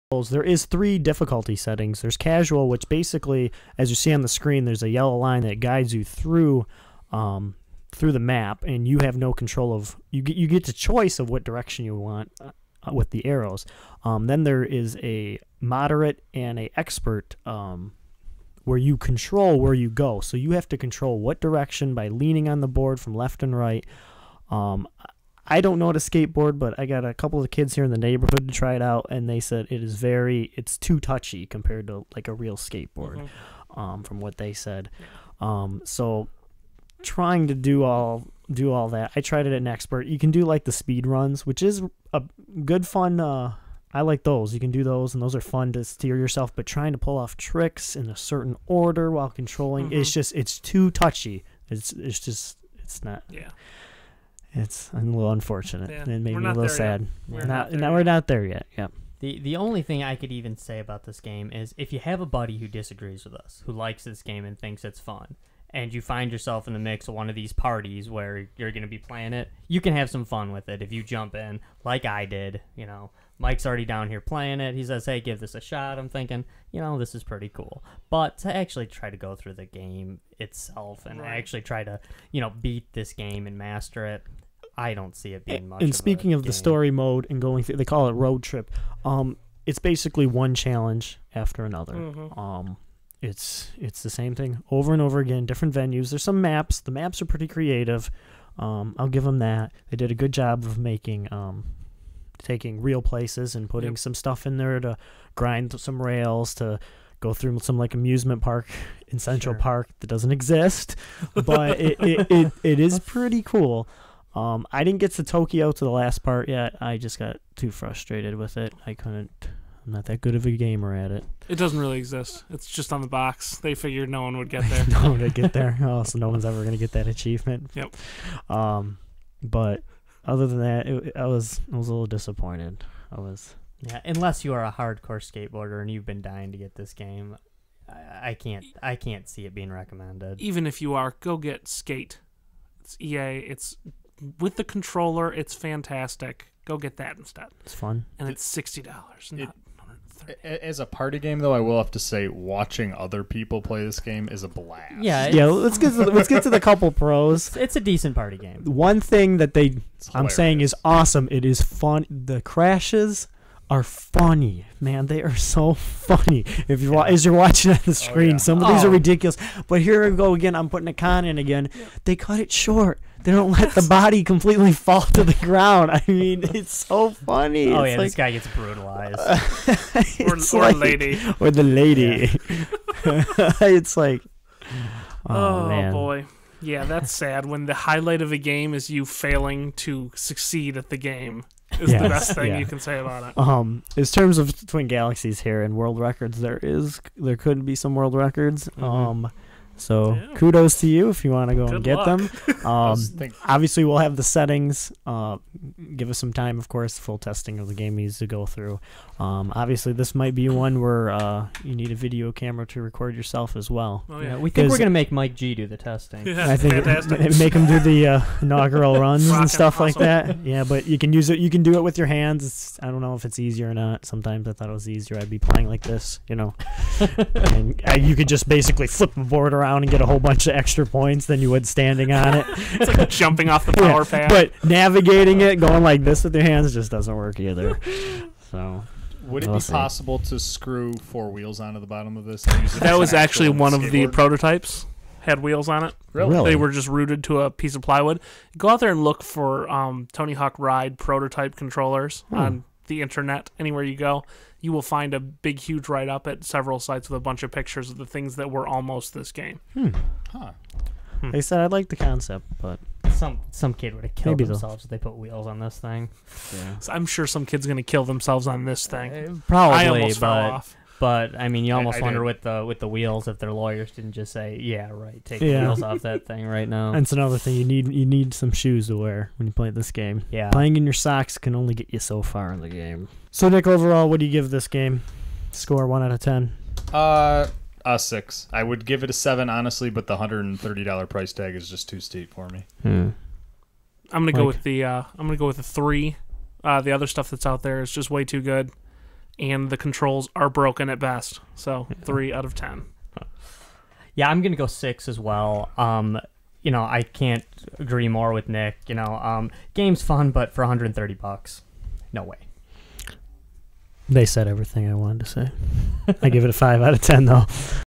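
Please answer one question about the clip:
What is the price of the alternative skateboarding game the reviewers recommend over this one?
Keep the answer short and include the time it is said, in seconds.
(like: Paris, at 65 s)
$60, at 148 s.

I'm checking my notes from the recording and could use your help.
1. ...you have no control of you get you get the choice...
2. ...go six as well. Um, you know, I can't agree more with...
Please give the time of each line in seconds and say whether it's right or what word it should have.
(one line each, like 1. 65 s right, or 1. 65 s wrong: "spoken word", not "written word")
1. 8 s right
2. 304 s right.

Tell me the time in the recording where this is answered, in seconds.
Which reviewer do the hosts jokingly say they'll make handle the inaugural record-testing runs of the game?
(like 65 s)
215 s.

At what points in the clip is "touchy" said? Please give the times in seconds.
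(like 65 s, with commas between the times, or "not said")
30 s, 50 s.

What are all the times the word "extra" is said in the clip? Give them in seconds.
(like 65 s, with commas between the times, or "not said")
230 s.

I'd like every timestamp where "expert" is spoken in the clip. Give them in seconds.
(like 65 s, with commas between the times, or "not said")
16 s, 39 s.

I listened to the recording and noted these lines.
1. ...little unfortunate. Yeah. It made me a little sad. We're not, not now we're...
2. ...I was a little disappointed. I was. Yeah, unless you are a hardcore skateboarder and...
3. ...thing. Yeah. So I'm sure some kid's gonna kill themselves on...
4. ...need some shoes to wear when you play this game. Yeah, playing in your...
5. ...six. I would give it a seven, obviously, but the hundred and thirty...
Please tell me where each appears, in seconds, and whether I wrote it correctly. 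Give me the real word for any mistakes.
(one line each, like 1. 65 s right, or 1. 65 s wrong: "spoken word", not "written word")
1. 54 s right
2. 131 s right
3. 265 s right
4. 278 s right
5. 287 s wrong: "honestly", not "obviously".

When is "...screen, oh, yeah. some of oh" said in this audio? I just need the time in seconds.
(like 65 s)
167 s.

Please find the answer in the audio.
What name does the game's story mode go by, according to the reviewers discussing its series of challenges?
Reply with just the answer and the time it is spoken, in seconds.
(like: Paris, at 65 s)
Road Trip, at 88 s.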